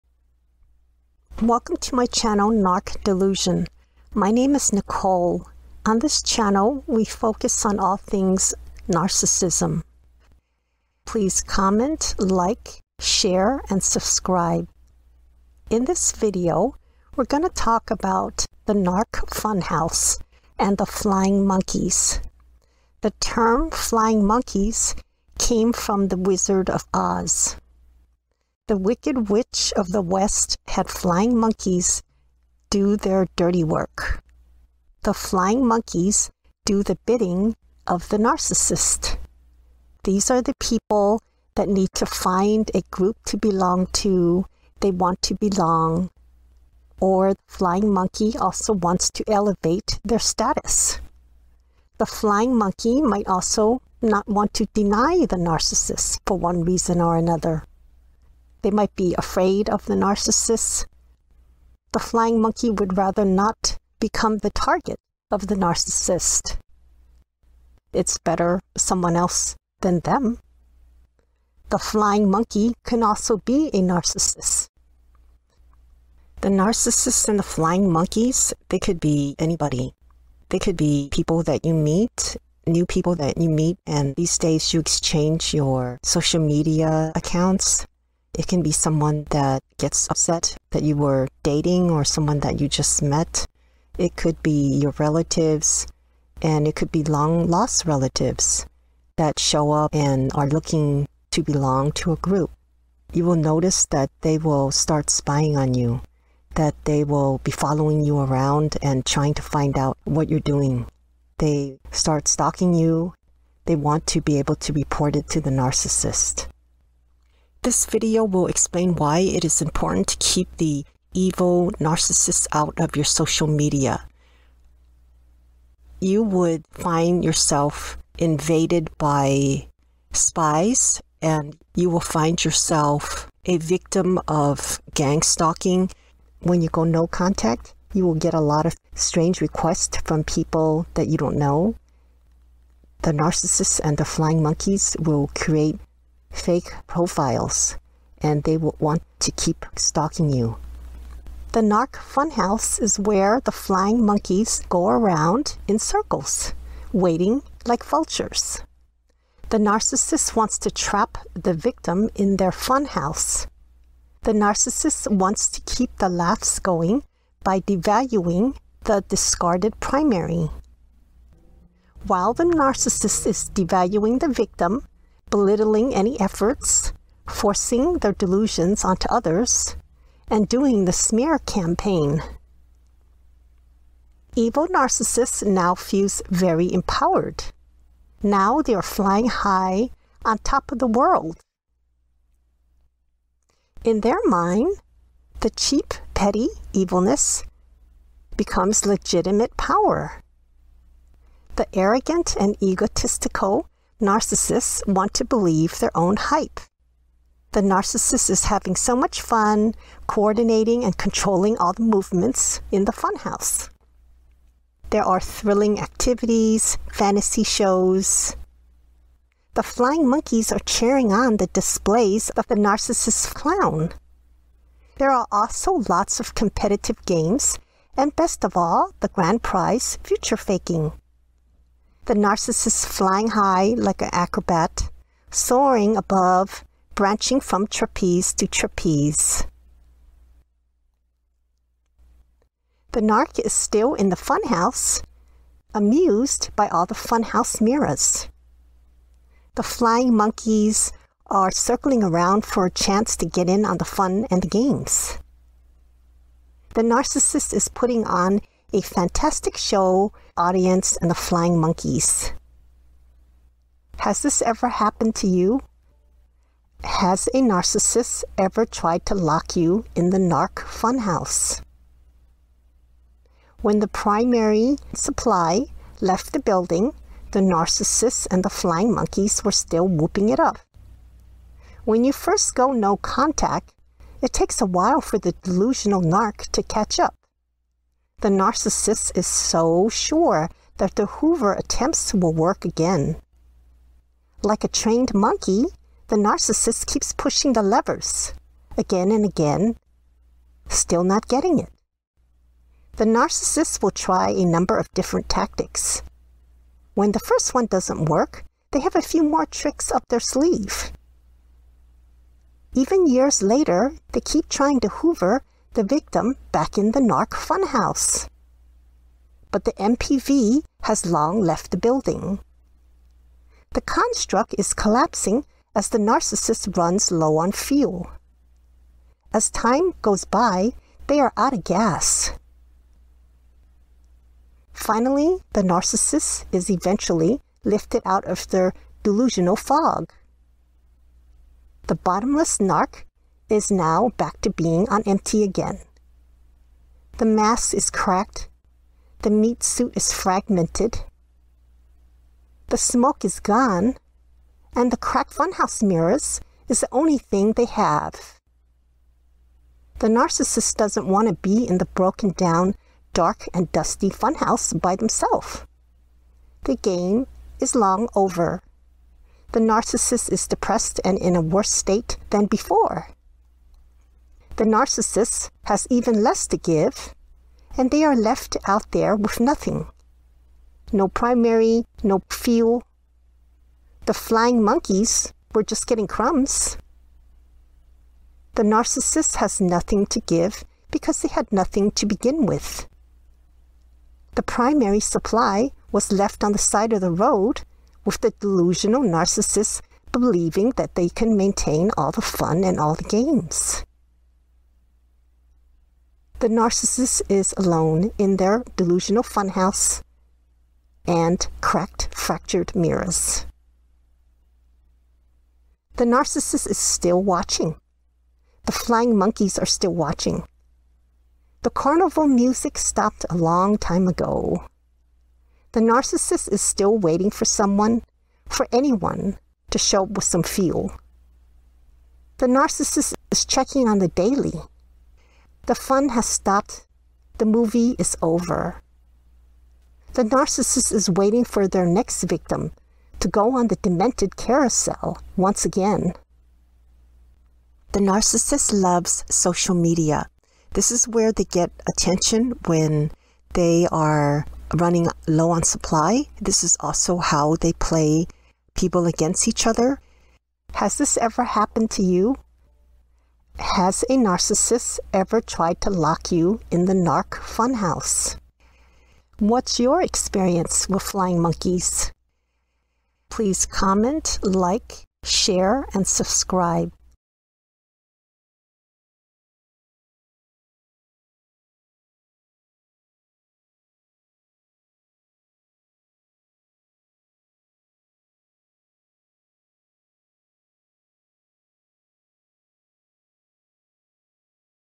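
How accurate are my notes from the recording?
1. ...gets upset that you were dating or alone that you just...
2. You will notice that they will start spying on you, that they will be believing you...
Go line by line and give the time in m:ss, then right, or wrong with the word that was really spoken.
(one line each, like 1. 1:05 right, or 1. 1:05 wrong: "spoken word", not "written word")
1. 1:29 wrong: "someone", not "alone"
2. 1:43 wrong: "following", not "believing".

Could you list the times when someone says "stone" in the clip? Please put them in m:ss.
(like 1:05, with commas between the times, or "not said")
not said.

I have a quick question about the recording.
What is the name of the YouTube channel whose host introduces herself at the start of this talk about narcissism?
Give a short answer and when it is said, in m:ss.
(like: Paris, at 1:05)
Narc Delusion, at 0:02.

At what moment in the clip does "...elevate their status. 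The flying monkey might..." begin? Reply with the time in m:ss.
0:49.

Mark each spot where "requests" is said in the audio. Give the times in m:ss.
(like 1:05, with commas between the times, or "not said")
2:19.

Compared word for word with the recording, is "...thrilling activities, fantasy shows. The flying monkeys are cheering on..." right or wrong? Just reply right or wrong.
right.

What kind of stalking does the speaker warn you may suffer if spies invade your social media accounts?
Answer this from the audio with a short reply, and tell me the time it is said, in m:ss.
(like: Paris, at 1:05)
Gang stalking, at 2:14.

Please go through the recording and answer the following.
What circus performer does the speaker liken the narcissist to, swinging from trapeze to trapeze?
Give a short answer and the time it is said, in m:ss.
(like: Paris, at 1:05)
An acrobat, at 3:54.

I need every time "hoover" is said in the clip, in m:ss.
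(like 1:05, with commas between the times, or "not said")
4:51, 5:14.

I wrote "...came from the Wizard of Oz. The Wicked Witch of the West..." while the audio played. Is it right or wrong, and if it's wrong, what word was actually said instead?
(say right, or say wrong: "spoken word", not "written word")
right.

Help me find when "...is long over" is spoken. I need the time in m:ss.
6:07.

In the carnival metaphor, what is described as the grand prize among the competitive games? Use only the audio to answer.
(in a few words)
Future faking.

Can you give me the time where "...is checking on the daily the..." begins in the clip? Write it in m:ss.
7:13.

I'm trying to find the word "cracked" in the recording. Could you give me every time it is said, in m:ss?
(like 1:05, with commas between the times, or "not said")
5:47, 5:54, 6:51.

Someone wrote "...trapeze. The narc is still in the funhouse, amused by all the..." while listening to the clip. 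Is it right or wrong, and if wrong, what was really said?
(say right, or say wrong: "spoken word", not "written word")
right.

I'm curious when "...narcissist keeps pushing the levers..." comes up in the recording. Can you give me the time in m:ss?
4:56.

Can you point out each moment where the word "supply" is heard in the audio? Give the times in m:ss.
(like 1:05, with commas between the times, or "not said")
4:34, 6:34, 7:35.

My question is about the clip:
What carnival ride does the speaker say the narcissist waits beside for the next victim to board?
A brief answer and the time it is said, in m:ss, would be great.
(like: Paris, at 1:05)
The demented carousel, at 7:23.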